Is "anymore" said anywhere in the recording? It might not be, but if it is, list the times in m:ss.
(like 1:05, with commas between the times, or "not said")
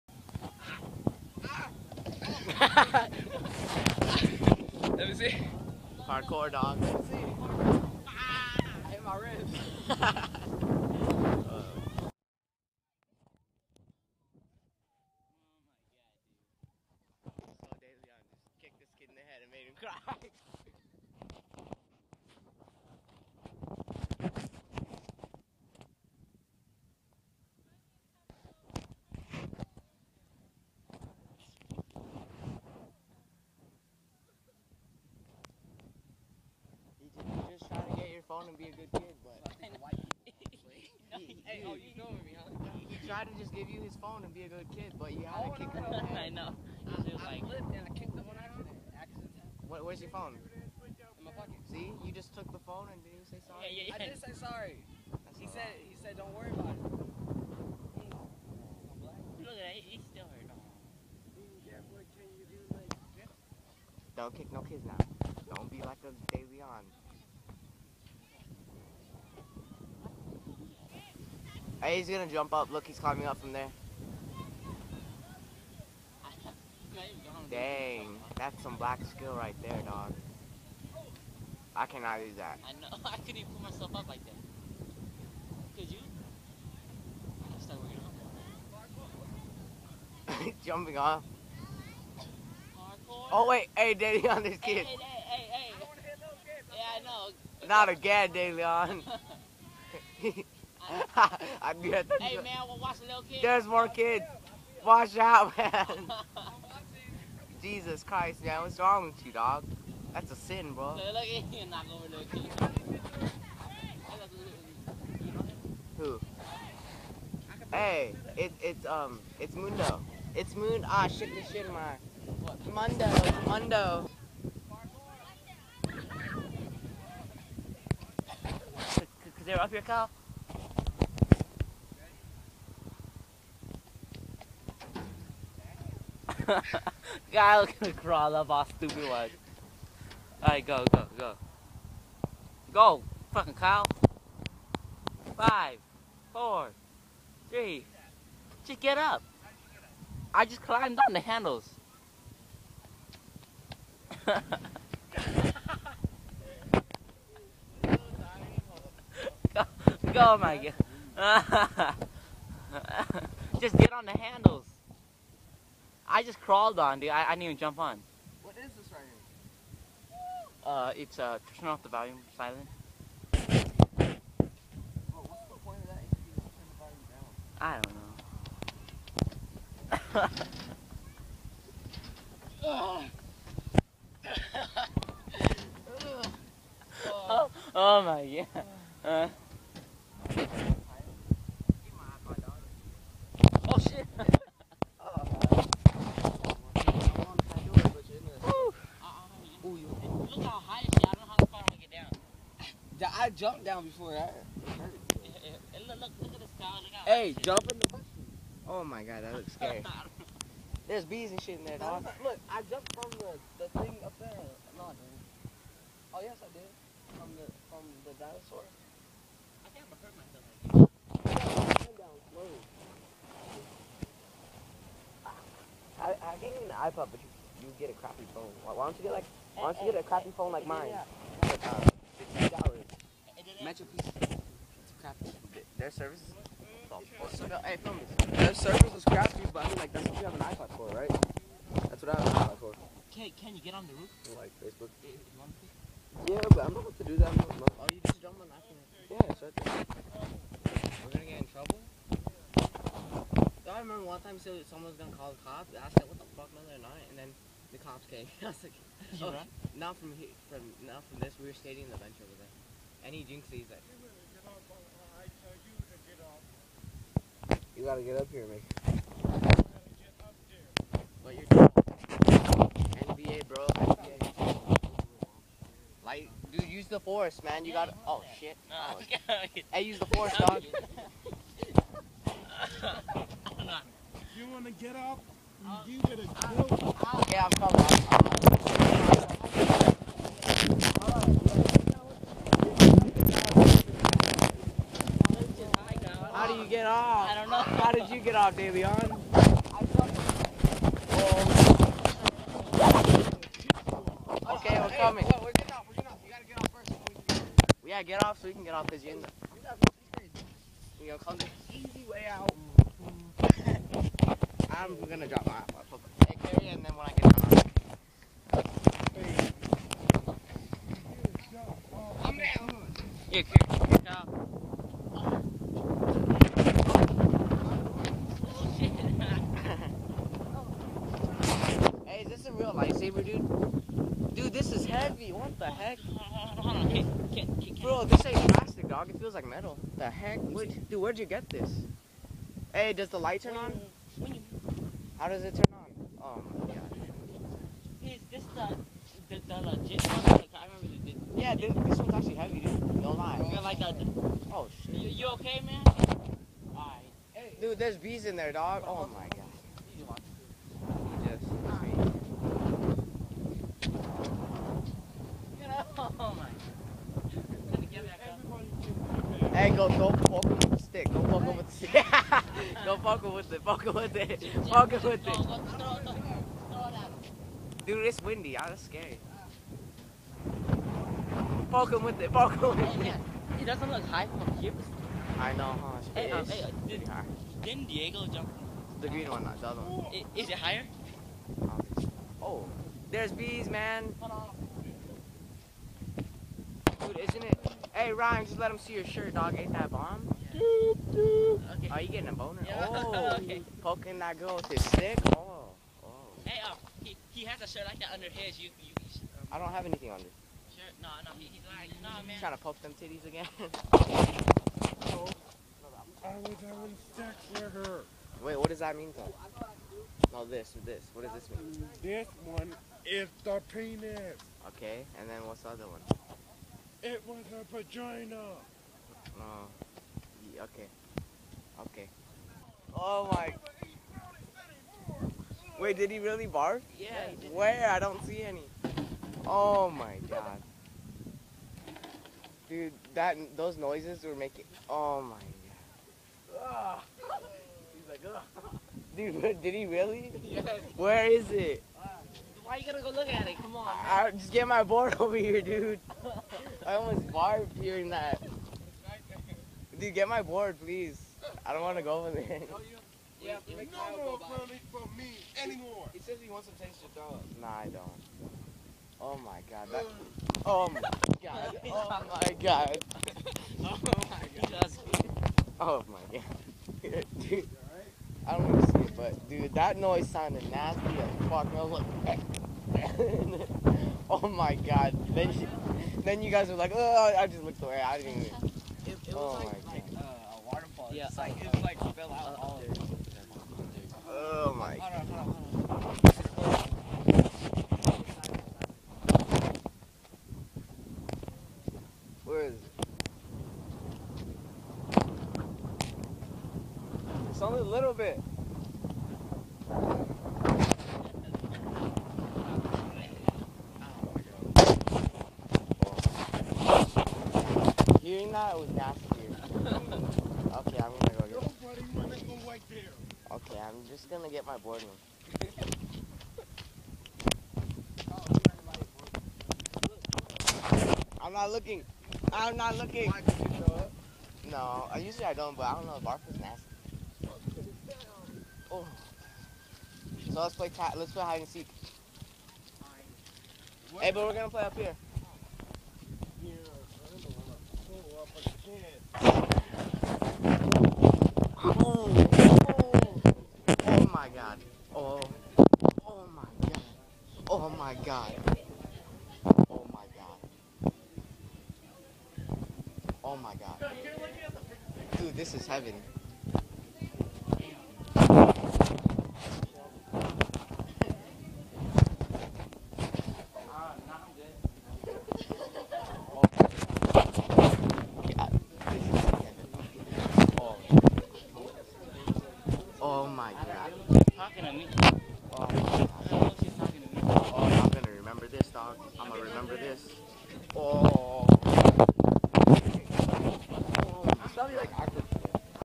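7:45.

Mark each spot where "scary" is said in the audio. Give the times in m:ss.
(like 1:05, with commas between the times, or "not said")
3:29, 6:18.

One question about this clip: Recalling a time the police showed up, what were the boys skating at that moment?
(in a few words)
The bench.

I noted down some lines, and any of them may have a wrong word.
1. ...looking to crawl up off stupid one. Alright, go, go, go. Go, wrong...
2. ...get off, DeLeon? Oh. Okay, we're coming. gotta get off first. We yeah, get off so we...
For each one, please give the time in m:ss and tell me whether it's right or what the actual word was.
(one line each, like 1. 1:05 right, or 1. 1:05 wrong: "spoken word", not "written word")
1. 2:17 wrong: "fucking", not "wrong"
2. 4:58 right.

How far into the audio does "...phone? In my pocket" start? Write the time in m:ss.
0:50.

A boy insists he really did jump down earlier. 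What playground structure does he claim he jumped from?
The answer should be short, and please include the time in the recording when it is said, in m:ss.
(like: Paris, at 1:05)
The dinosaur, at 3:38.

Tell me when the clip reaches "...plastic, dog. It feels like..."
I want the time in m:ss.
5:38.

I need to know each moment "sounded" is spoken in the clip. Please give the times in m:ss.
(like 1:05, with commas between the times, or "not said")
8:00.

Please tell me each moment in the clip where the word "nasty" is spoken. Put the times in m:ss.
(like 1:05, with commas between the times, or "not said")
8:00, 8:38, 8:56.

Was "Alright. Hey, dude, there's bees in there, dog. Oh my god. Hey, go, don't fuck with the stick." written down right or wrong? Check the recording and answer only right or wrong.
right.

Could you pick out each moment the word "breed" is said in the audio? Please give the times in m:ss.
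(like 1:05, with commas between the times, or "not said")
not said.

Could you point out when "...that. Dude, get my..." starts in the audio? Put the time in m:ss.
7:38.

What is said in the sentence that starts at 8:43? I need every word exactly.
Okay, I'm just gonna get my board room.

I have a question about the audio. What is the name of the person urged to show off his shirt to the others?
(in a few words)
Ryan.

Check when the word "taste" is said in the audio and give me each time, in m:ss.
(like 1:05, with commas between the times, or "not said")
7:46.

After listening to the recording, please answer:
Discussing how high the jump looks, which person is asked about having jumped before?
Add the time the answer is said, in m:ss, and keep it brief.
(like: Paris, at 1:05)
Diego, at 6:27.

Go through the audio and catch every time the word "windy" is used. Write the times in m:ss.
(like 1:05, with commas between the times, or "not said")
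6:18.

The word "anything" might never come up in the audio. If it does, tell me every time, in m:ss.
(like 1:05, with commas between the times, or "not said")
6:49.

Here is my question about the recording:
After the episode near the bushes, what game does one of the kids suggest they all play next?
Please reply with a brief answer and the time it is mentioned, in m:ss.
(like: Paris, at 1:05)
Hide and seek, at 9:01.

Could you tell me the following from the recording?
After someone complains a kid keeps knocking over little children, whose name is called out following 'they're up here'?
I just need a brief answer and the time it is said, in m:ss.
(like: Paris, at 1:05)
Kyle, at 2:09.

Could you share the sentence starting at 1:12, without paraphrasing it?
Look, he's climbing up from there.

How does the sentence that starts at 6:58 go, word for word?
Wait, what does that mean, though?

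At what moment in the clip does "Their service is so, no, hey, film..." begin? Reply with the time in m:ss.
3:55.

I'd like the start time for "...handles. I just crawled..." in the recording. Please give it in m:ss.
2:44.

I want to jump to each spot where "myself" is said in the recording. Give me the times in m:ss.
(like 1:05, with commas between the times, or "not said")
1:23, 3:41.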